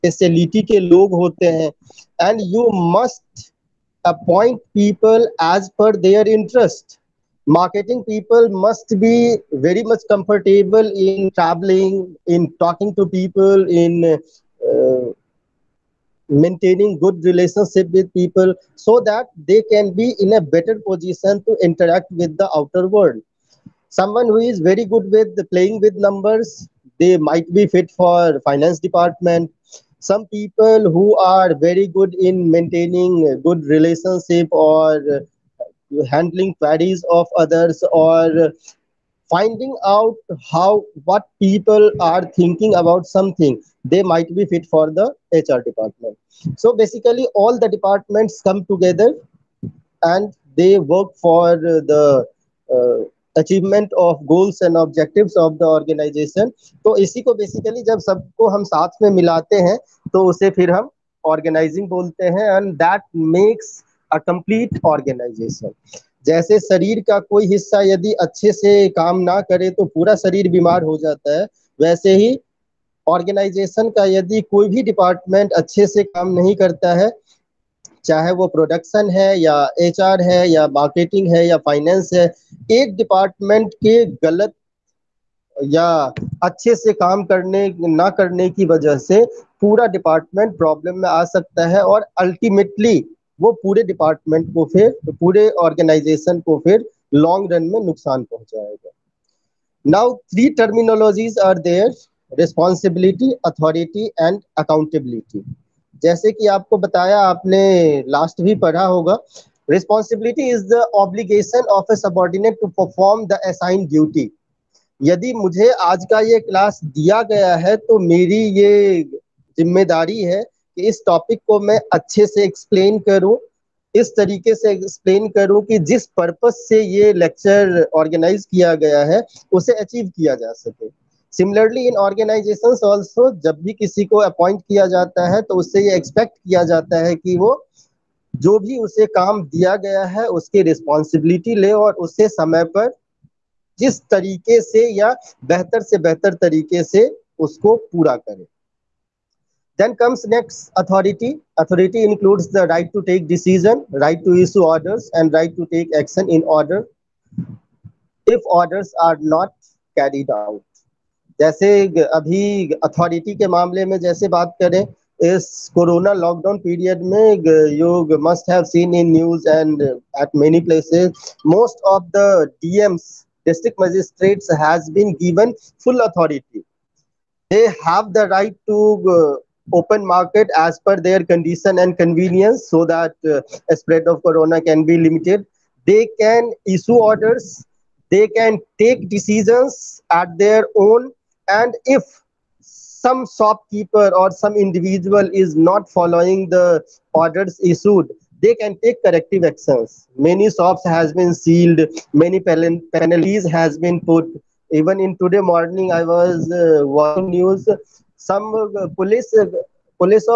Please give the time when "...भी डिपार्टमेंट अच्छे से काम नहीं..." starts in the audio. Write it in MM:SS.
01:14.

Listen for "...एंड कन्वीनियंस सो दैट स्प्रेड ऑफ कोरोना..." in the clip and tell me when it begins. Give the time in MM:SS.
03:01.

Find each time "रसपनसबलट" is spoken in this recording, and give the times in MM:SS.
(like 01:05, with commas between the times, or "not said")
01:42, 01:49, 02:20.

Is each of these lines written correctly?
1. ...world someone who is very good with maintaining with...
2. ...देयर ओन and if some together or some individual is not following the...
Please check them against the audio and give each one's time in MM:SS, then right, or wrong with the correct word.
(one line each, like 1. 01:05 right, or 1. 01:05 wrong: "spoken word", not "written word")
1. 00:22 wrong: "playing", not "maintaining"
2. 03:10 wrong: "shopkeeper", not "together".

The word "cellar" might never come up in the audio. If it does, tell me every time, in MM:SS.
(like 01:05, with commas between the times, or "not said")
not said.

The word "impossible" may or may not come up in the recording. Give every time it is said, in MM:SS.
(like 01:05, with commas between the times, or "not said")
not said.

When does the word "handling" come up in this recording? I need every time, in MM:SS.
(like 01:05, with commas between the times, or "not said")
00:36.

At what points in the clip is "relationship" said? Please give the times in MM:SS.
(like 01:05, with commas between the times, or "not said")
00:17, 00:33.